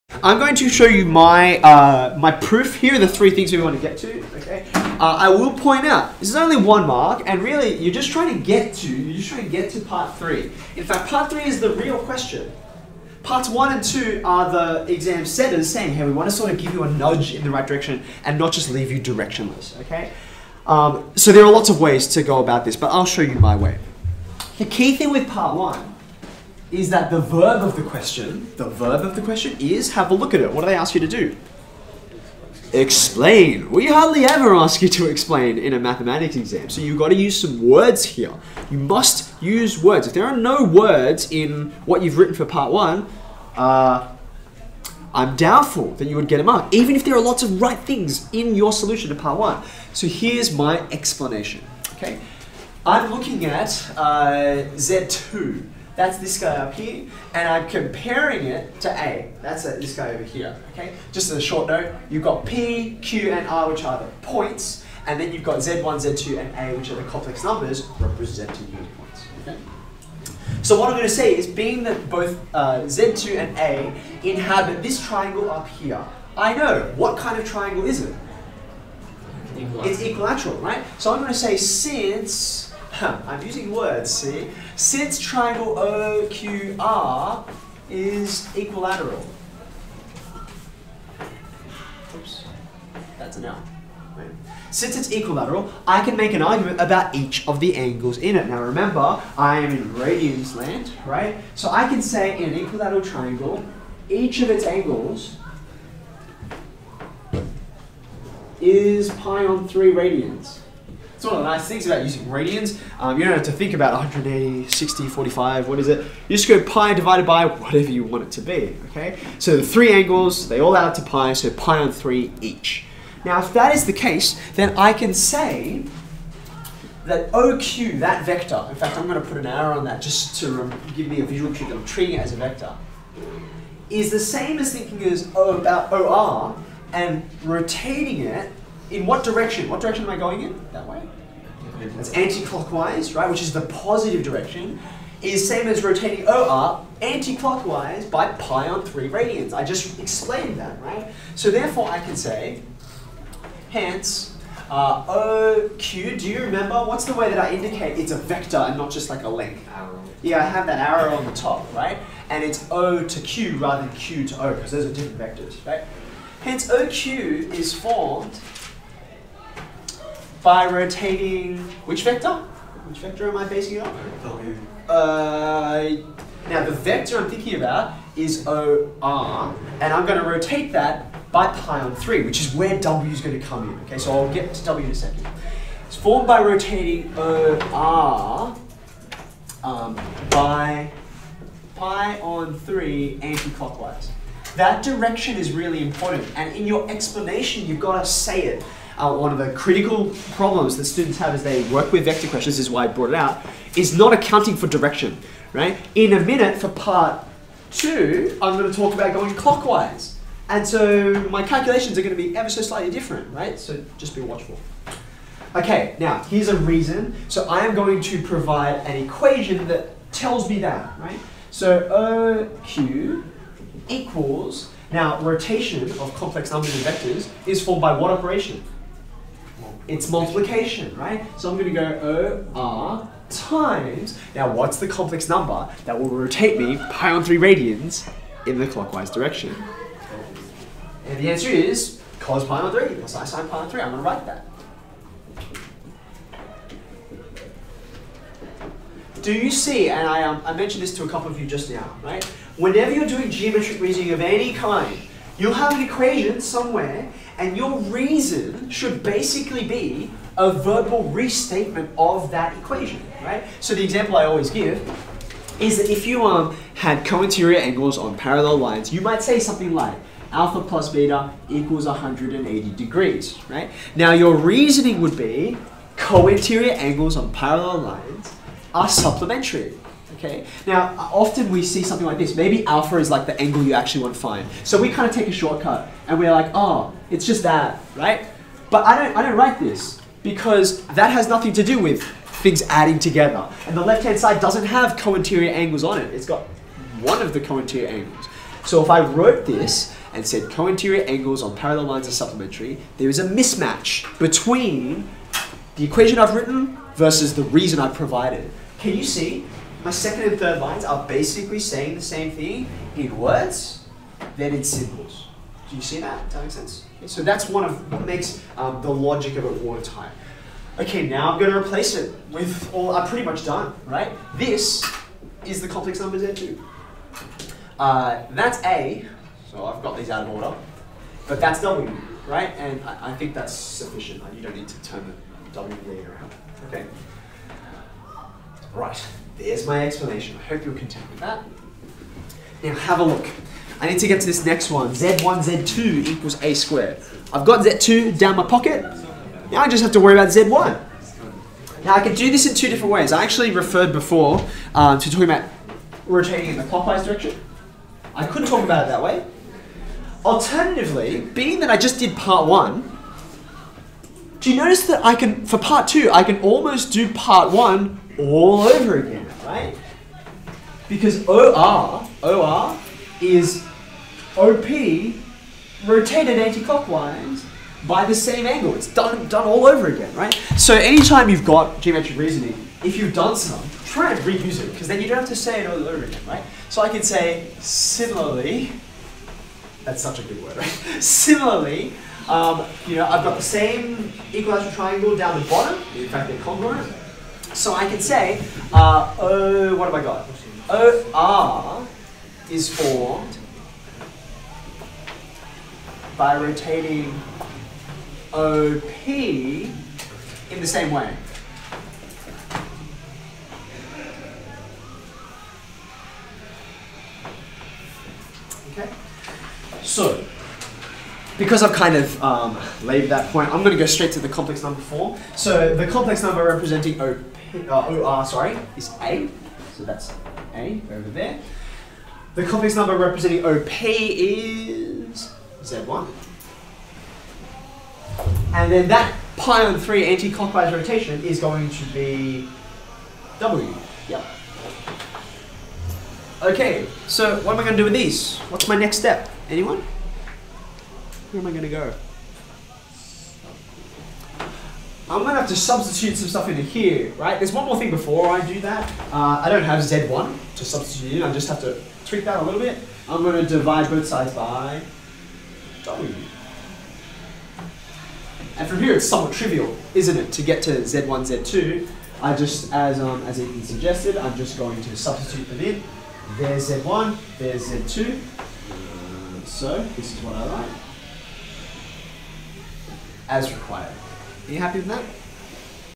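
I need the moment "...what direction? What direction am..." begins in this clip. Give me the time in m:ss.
2:19.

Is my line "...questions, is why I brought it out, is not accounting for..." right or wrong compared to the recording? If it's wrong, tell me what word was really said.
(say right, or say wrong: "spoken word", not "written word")
right.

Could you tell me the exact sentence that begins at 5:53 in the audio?
I actually referred before um, to talking about rotating in the clockwise direction.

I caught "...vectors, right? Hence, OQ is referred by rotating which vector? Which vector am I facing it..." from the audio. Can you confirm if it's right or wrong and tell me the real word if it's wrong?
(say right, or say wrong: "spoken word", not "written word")
wrong: "formed", not "referred".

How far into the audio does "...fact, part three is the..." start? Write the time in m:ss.
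0:10.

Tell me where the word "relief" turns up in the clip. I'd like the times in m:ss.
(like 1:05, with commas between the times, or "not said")
not said.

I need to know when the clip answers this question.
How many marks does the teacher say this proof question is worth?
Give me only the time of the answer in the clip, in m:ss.
0:06.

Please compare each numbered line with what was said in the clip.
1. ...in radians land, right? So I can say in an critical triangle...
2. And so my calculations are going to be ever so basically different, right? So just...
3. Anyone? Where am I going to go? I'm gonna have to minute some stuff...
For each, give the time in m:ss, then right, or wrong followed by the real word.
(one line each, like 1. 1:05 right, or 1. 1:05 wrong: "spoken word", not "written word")
1. 1:39 wrong: "equilateral", not "critical"
2. 3:30 wrong: "slightly", not "basically"
3. 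7:29 wrong: "substitute", not "minute".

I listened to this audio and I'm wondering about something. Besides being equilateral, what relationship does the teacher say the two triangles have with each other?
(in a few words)
Congruent.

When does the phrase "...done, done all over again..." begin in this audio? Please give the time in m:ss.
6:18.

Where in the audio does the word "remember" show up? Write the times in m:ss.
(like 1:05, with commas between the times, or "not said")
1:38, 2:36.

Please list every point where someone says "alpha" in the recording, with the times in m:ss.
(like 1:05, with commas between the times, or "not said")
4:30, 4:42.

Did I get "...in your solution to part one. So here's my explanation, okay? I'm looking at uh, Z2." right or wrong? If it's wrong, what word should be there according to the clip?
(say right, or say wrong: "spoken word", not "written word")
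right.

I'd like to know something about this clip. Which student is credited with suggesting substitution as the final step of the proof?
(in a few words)
Ethan.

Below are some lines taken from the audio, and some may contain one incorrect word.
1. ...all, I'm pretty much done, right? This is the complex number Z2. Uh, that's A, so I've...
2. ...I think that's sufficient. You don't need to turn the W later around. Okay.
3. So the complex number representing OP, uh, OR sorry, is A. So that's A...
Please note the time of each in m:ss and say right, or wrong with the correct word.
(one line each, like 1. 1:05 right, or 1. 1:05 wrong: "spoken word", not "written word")
1. 5:22 right
2. 5:33 right
3. 7:05 right.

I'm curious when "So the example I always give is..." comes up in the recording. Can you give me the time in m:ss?
4:23.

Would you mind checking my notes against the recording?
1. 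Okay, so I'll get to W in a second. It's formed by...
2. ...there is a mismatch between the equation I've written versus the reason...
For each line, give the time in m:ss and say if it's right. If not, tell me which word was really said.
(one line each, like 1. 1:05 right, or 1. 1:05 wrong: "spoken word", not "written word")
1. 3:03 right
2. 5:02 right.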